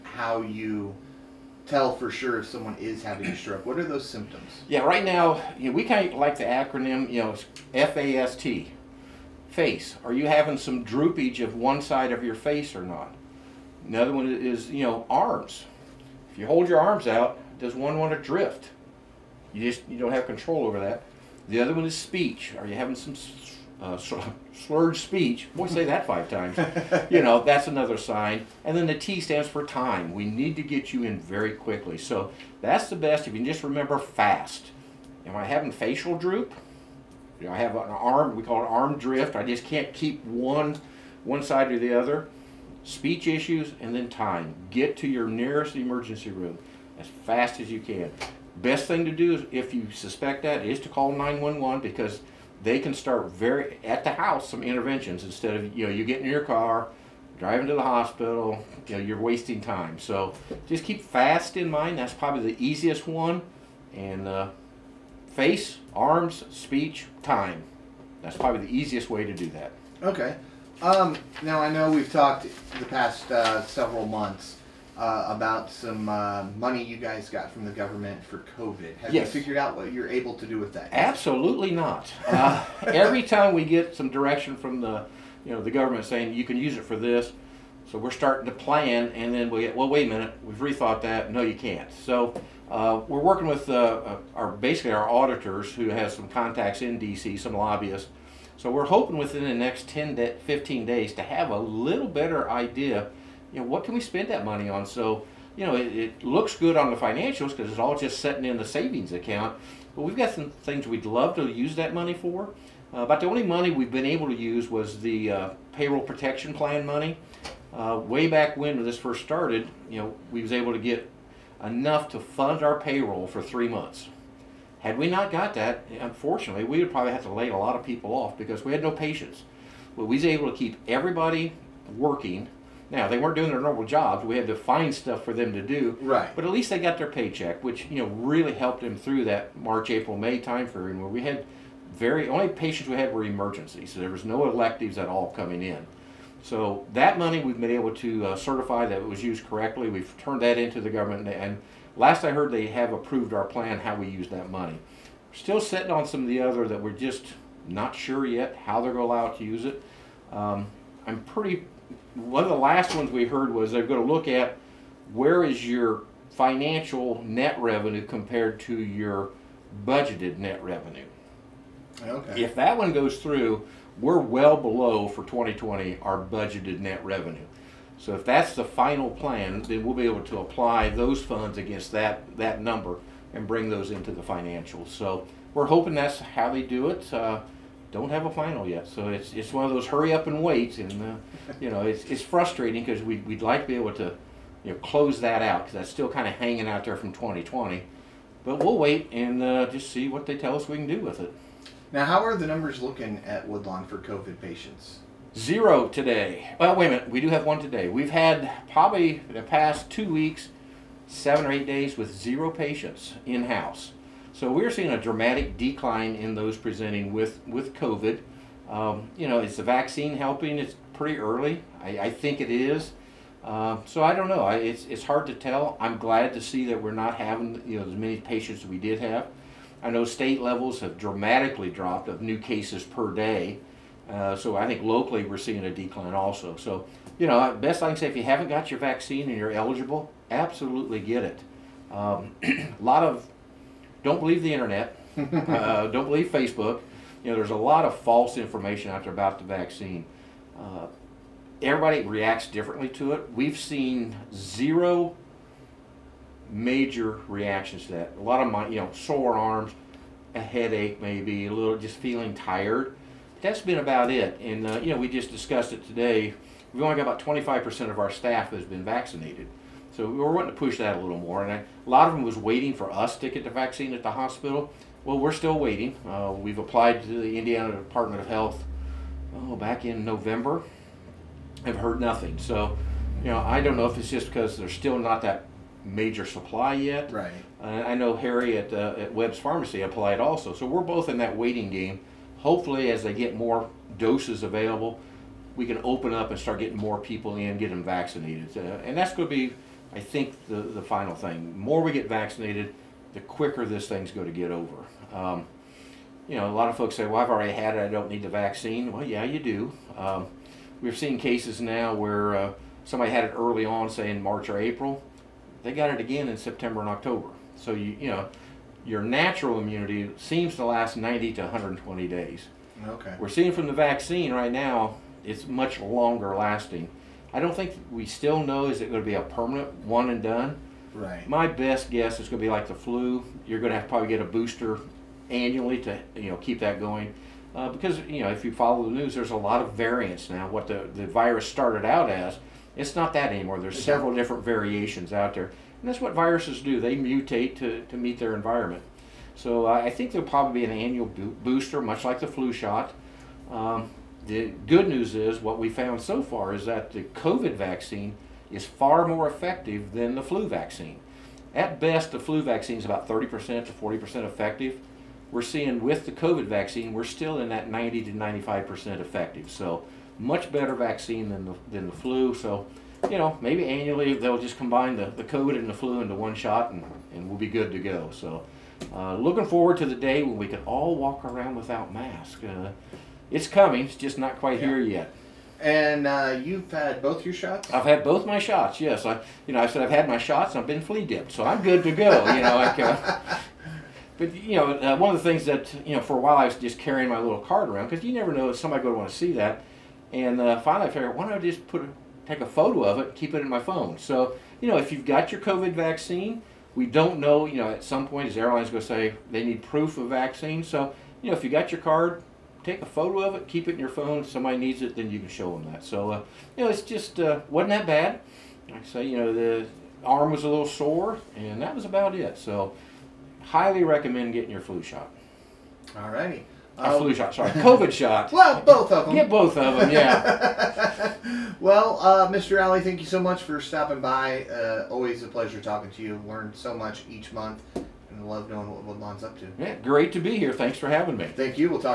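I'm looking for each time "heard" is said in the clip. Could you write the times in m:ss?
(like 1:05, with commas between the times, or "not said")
2:32, 2:43, 4:41.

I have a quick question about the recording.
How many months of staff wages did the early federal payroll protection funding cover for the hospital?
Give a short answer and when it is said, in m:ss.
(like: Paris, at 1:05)
3, at 2:03.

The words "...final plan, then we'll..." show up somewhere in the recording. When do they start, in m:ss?
2:58.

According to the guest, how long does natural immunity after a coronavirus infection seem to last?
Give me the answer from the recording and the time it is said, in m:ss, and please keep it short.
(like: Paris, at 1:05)
90 to 120 days, at 5:20.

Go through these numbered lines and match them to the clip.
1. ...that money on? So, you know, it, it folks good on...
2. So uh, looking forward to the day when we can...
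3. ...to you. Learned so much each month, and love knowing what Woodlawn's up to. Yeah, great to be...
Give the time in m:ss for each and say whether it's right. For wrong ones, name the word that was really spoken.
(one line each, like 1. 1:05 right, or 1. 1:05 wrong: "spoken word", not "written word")
1. 1:44 wrong: "looks", not "folks"
2. 6:18 right
3. 7:15 right.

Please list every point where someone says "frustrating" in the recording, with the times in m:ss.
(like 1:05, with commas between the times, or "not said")
3:12.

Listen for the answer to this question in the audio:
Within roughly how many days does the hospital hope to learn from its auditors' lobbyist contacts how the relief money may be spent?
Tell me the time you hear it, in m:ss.
1:39.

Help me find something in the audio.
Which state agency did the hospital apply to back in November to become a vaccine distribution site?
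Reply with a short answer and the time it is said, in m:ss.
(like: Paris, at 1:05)
Indiana Department of Health, at 4:37.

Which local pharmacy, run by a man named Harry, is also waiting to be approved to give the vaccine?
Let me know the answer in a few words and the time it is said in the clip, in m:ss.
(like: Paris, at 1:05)
Webb's Pharmacy, at 4:49.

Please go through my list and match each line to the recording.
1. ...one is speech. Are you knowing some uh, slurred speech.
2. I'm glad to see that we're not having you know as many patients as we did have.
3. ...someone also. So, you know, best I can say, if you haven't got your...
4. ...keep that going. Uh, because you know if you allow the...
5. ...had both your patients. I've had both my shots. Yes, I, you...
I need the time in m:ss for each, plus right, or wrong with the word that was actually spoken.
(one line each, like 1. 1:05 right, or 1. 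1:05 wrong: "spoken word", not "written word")
1. 0:21 wrong: "having", not "knowing"
2. 3:45 right
3. 3:55 wrong: "decline", not "someone"
4. 5:36 wrong: "follow", not "allow"
5. 6:26 wrong: "shots", not "patients".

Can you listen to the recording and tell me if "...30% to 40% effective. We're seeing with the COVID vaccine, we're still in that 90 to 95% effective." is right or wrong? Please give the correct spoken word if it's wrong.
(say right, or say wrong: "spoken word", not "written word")
right.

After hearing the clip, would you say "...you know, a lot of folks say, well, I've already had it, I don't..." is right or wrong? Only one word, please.
right.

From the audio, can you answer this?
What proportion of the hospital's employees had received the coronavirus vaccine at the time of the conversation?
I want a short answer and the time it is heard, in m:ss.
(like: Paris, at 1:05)
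25%, at 4:27.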